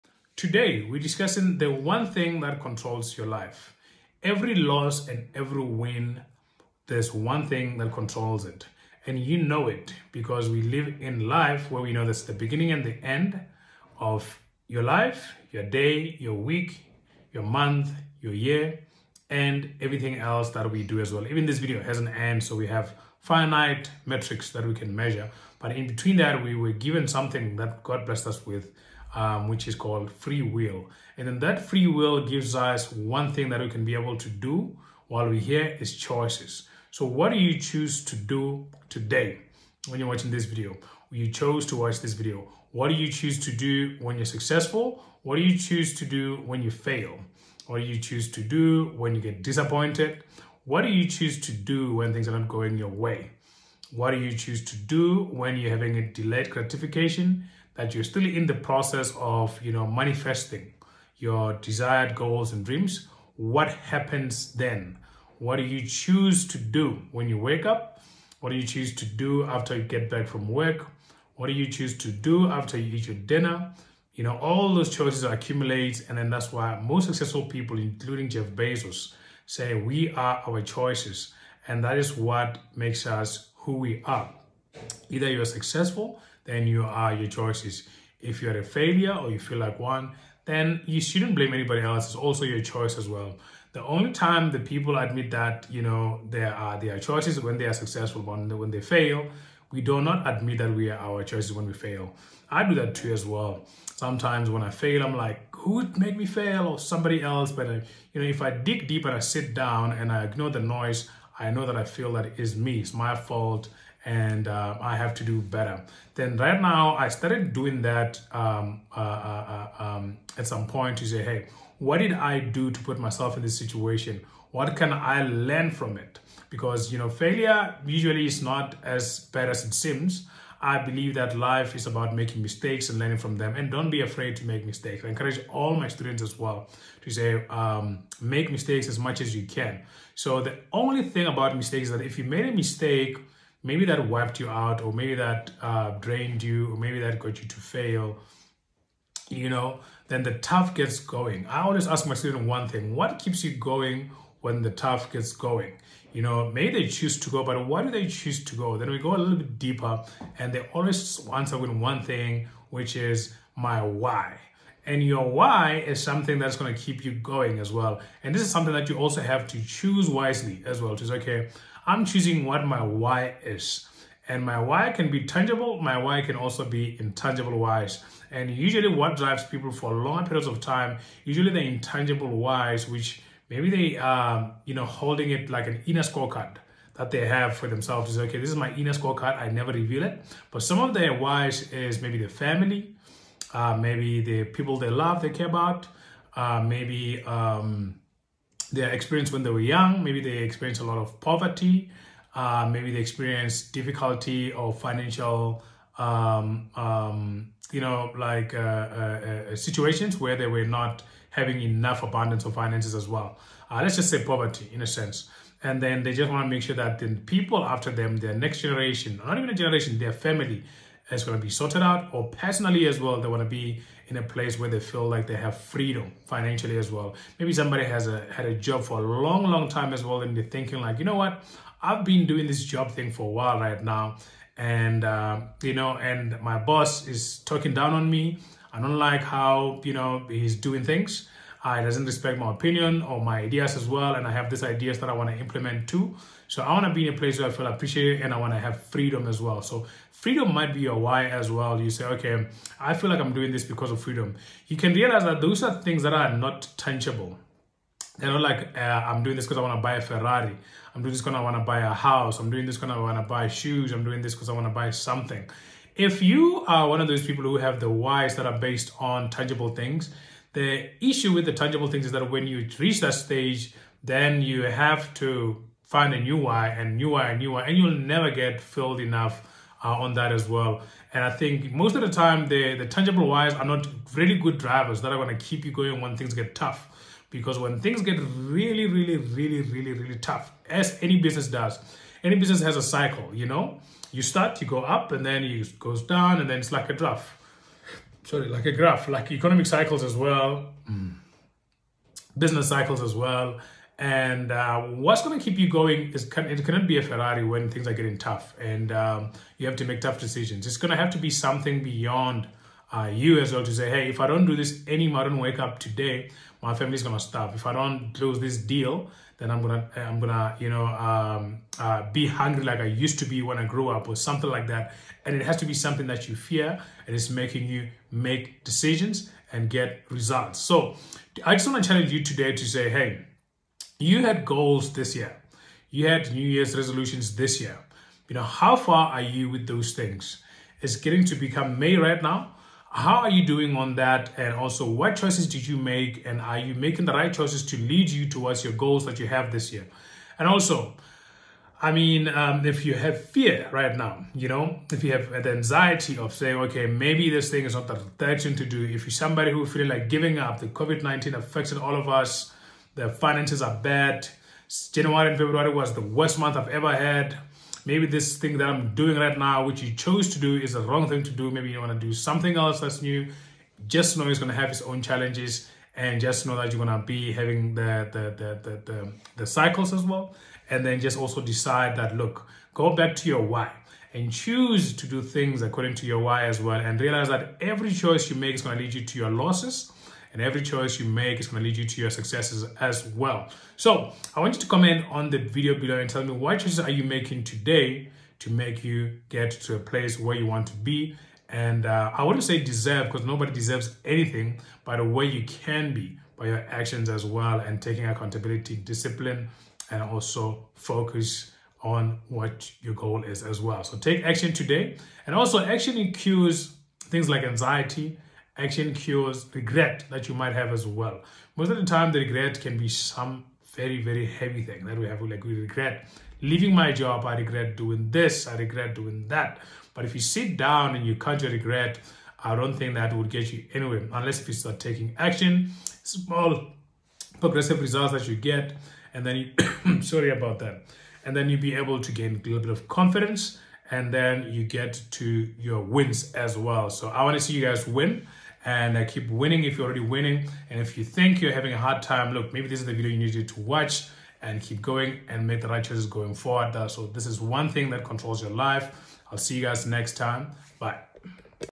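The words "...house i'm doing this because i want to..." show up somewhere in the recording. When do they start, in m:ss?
4:21.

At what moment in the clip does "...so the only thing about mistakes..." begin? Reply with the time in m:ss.
2:20.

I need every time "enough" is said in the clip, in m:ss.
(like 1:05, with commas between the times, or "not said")
3:31, 4:38.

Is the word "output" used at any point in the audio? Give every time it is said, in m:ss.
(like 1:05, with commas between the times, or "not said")
not said.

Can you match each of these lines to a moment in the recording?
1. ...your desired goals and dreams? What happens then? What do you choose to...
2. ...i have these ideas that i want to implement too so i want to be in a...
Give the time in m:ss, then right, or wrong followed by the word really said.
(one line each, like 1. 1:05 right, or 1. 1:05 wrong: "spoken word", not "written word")
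1. 1:01 right
2. 4:04 right.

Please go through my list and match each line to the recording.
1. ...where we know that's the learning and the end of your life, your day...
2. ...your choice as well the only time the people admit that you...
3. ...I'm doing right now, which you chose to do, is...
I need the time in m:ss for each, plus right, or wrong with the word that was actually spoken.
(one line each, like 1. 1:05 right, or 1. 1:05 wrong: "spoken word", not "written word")
1. 0:11 wrong: "beginning", not "learning"
2. 1:32 right
3. 6:08 right.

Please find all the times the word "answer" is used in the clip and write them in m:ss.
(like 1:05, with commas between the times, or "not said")
2:41.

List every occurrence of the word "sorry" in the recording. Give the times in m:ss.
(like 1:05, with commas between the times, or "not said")
4:58, 7:20.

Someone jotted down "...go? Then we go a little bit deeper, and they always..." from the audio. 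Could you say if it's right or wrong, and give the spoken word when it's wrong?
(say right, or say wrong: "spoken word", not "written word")
right.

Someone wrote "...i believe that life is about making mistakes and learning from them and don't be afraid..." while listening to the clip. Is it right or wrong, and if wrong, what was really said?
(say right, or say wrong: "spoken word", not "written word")
right.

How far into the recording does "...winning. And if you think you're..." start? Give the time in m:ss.
7:30.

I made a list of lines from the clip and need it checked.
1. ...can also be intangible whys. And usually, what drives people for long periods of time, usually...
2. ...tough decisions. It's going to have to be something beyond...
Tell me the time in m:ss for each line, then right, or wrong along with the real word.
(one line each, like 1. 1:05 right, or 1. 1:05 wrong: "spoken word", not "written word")
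1. 2:56 right
2. 5:10 right.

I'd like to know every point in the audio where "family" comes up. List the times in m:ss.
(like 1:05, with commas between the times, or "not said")
3:12, 3:40, 5:16.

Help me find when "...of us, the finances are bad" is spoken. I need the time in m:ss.
6:01.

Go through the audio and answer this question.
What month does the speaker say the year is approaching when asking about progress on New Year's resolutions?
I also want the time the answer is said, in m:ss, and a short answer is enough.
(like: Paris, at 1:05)
May, at 5:41.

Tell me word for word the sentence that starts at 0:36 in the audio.
So, what do you choose to do today when you're watching this video?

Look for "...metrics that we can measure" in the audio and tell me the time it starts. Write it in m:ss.
0:24.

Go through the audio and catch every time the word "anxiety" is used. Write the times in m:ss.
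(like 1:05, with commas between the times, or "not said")
5:55, 6:57.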